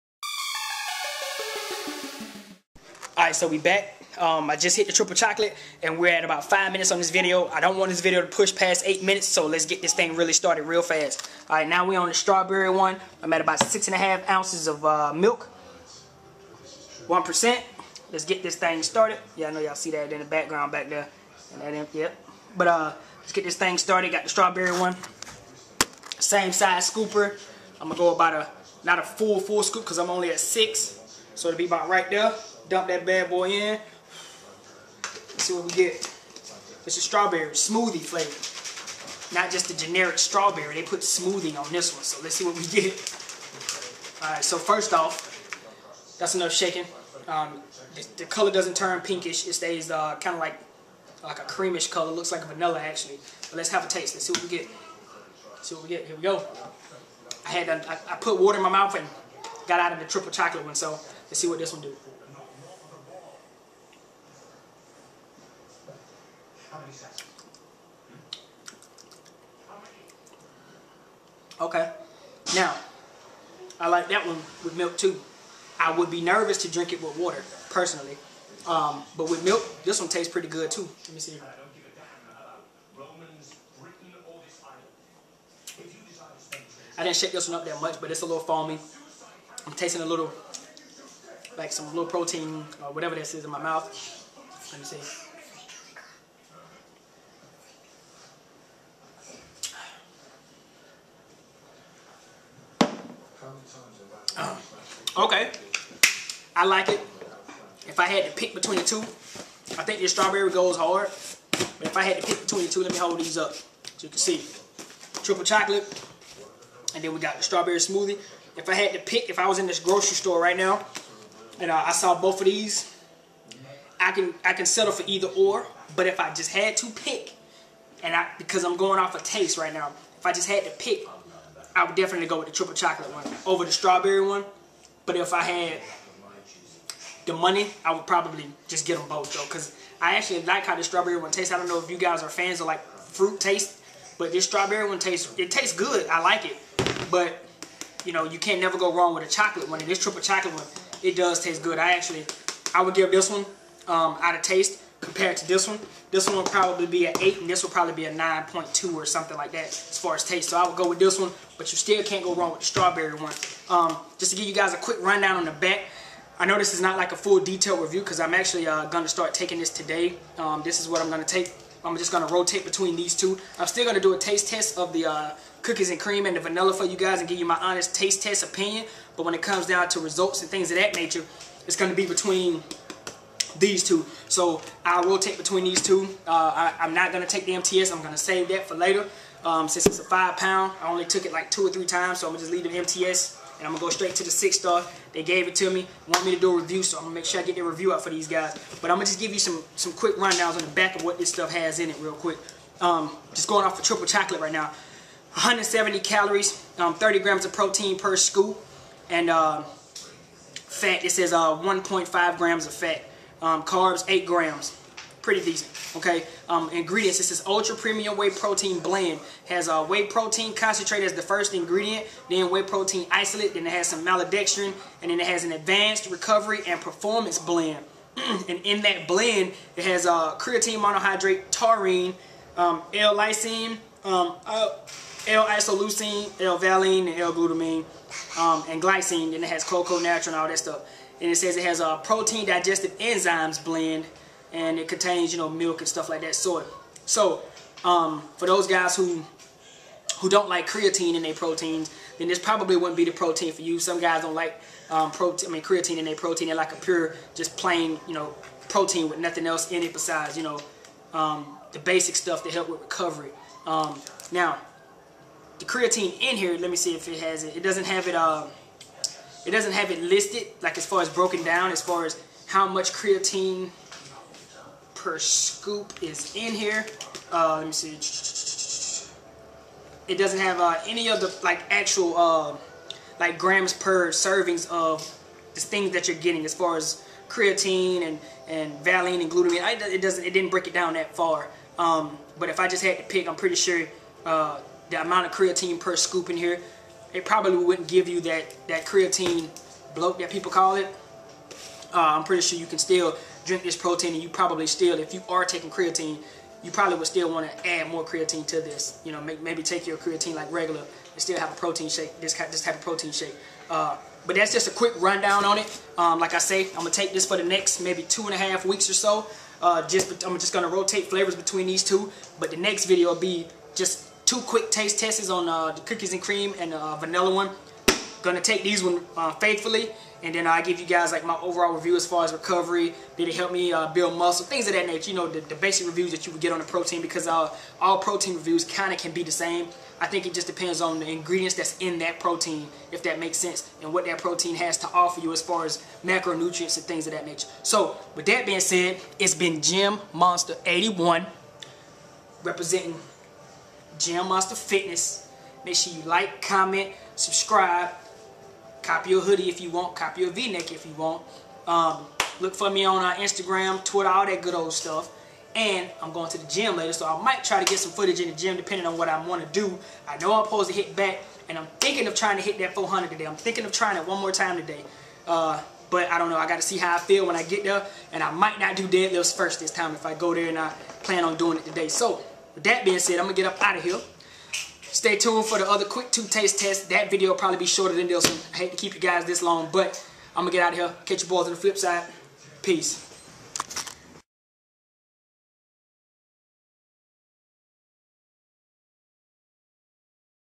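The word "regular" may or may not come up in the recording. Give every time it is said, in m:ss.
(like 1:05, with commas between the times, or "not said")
5:10.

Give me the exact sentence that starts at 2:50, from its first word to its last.
Um, this is what I'm going to take.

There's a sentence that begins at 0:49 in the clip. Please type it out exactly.
It stays uh, kind of like like a creamish color.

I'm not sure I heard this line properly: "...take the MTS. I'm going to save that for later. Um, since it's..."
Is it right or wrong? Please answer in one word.
right.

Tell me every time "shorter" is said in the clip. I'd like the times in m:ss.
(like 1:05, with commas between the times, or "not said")
6:27.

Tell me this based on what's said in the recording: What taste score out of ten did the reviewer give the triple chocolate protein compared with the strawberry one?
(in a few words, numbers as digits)
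9.2.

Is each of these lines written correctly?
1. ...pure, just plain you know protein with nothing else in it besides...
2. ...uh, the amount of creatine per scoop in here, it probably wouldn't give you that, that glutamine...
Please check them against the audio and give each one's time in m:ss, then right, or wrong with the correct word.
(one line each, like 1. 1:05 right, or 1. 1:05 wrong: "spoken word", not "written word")
1. 4:16 right
2. 4:54 wrong: "creatine", not "glutamine".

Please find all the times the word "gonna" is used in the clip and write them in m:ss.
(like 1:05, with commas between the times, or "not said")
0:27, 5:28.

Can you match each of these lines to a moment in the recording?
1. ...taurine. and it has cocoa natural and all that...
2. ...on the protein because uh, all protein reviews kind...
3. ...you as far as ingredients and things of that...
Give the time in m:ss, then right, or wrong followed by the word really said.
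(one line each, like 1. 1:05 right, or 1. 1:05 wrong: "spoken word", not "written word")
1. 3:58 wrong: "glycine", not "taurine"
2. 5:36 right
3. 5:45 wrong: "macronutrients", not "ingredients".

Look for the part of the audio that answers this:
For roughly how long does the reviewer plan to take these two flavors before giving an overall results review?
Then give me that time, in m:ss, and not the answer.
5:18.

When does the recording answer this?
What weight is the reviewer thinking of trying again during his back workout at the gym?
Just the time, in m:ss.
6:12.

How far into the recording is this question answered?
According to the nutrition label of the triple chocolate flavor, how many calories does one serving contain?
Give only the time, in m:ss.
3:25.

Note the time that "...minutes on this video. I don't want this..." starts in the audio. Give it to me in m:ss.
0:06.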